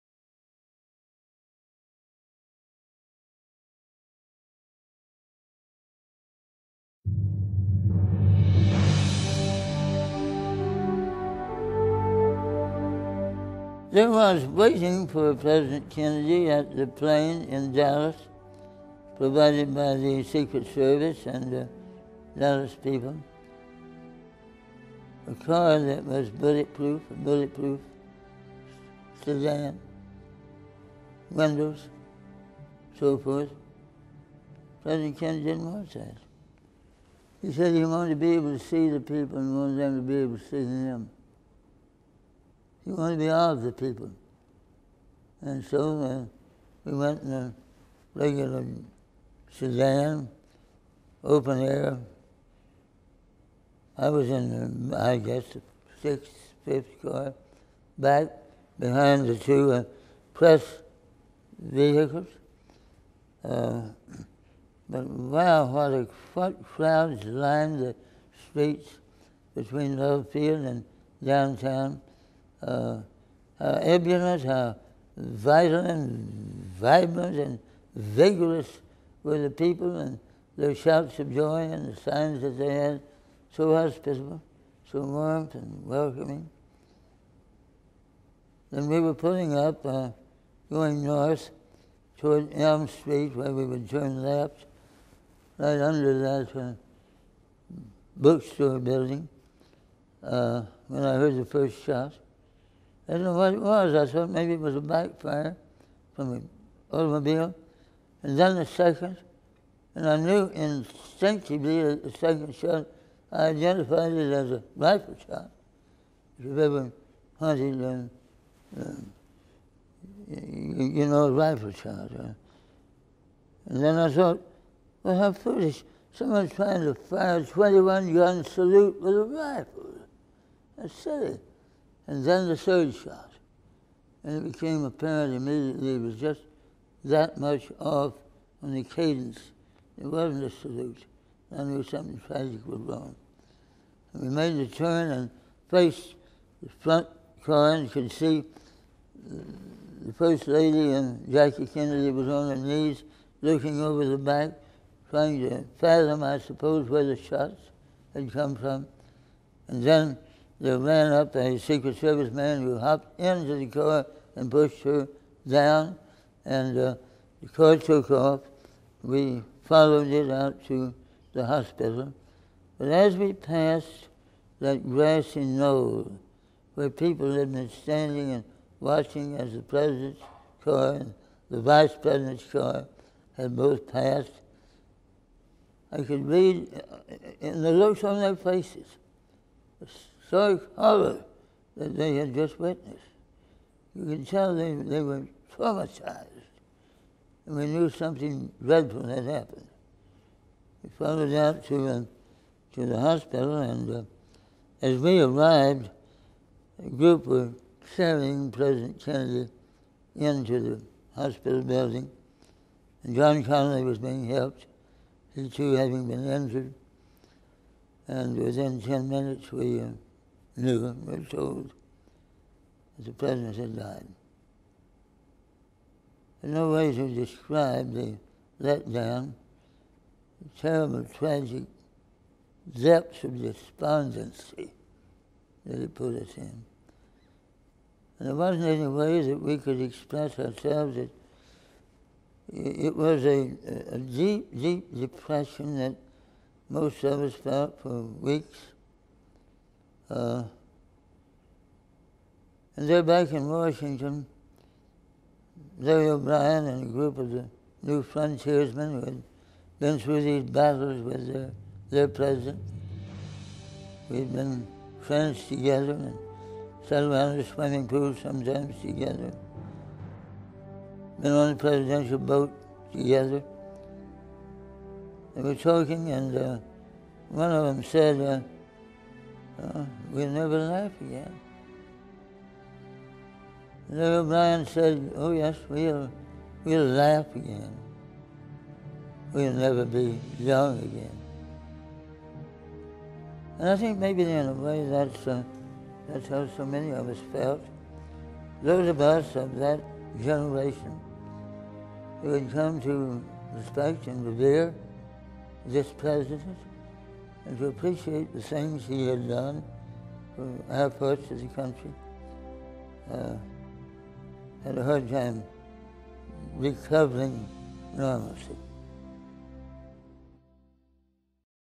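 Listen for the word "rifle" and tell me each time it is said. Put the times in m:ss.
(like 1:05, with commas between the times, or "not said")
1:54, 2:01, 2:09.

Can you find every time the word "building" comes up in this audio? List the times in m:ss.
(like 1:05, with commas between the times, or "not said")
1:38, 3:31.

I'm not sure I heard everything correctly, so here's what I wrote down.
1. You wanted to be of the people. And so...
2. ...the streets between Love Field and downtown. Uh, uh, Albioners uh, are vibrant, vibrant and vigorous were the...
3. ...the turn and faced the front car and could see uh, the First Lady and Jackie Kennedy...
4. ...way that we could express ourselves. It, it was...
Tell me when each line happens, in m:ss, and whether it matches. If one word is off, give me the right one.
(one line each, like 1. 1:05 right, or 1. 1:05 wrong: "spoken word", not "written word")
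1. 0:42 right
2. 1:07 right
3. 2:24 right
4. 3:58 right.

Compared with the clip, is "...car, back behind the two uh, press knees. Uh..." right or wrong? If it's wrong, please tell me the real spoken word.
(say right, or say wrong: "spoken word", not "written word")
wrong: "vehicles", not "knees".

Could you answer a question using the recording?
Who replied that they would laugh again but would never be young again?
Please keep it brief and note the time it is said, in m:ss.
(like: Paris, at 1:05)
Larry O'Brien, at 4:15.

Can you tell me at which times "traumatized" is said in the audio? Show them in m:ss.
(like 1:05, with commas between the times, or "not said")
3:15.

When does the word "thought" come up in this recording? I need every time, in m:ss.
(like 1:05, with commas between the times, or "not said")
1:44, 2:04.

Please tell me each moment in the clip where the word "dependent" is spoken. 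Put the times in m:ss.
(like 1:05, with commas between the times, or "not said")
not said.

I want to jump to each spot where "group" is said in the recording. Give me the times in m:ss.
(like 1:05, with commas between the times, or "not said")
3:26, 4:16.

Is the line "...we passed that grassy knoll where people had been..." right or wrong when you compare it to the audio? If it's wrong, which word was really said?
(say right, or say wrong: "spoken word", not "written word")
right.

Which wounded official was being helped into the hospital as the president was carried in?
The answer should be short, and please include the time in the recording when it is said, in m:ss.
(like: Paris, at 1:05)
John Connolly, at 3:33.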